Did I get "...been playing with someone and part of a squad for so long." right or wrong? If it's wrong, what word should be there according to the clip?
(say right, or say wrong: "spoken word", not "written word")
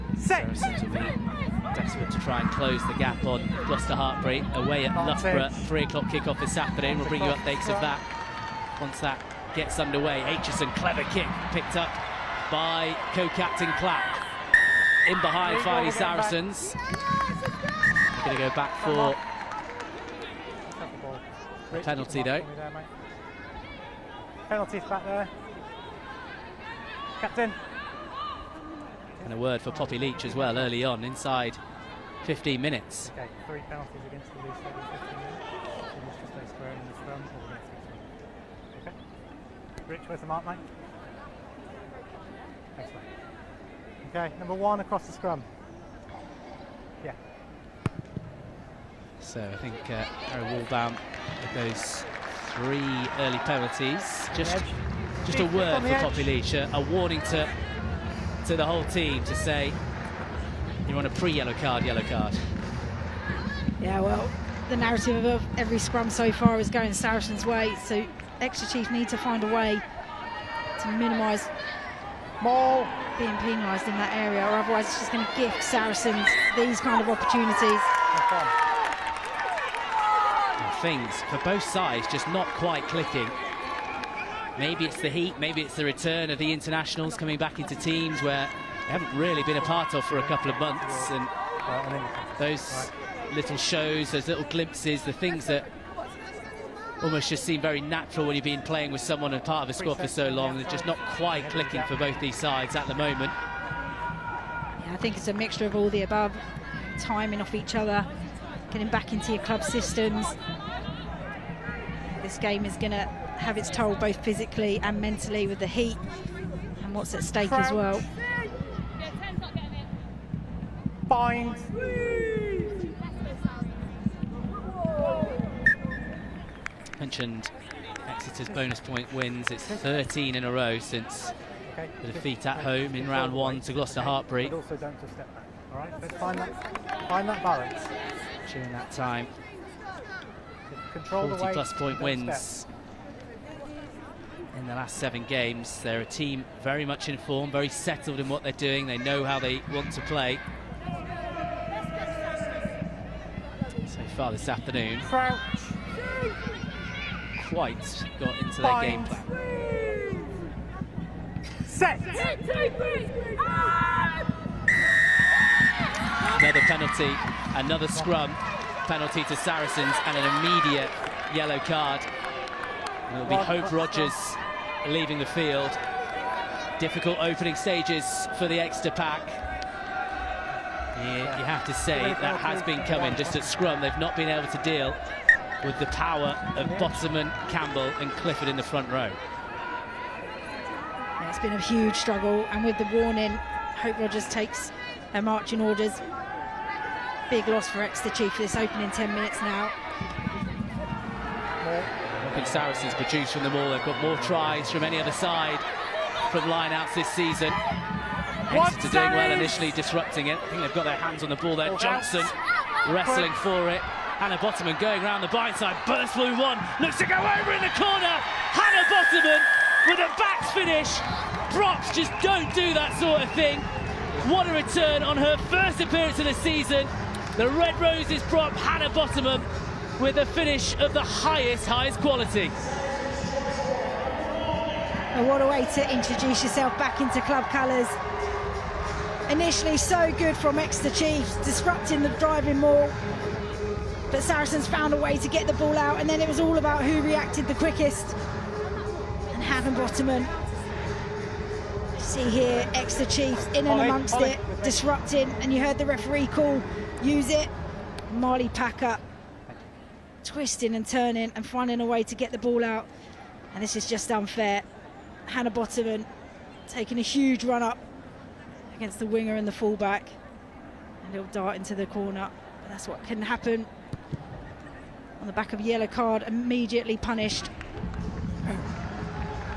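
right.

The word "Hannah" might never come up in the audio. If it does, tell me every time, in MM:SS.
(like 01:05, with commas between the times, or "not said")
03:34, 03:38, 03:48, 04:09, 04:25.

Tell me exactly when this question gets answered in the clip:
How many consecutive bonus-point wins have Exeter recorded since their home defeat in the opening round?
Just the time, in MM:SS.
02:09.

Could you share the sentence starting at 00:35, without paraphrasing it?
You must square in the scrum or the next six Okay.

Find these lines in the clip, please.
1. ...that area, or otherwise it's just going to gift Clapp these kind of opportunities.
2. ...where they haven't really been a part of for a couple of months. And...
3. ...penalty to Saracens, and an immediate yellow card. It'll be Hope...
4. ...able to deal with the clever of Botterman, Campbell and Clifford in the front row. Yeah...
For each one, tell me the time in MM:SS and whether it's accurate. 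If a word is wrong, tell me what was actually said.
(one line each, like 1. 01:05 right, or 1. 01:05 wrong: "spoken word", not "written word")
1. 01:13 wrong: "Saracens", not "Clapp"
2. 01:28 right
3. 02:48 right
4. 03:04 wrong: "power", not "clever".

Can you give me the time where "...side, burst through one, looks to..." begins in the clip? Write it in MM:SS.
03:35.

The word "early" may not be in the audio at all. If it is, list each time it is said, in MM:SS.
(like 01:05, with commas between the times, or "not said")
00:30, 00:53.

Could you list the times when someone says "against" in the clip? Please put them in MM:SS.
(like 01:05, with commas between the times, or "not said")
00:34, 04:28.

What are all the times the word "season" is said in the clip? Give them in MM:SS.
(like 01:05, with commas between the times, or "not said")
03:27, 03:46.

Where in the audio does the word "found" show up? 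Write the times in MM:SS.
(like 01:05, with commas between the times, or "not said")
04:04.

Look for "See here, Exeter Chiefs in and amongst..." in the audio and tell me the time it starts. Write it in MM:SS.
04:11.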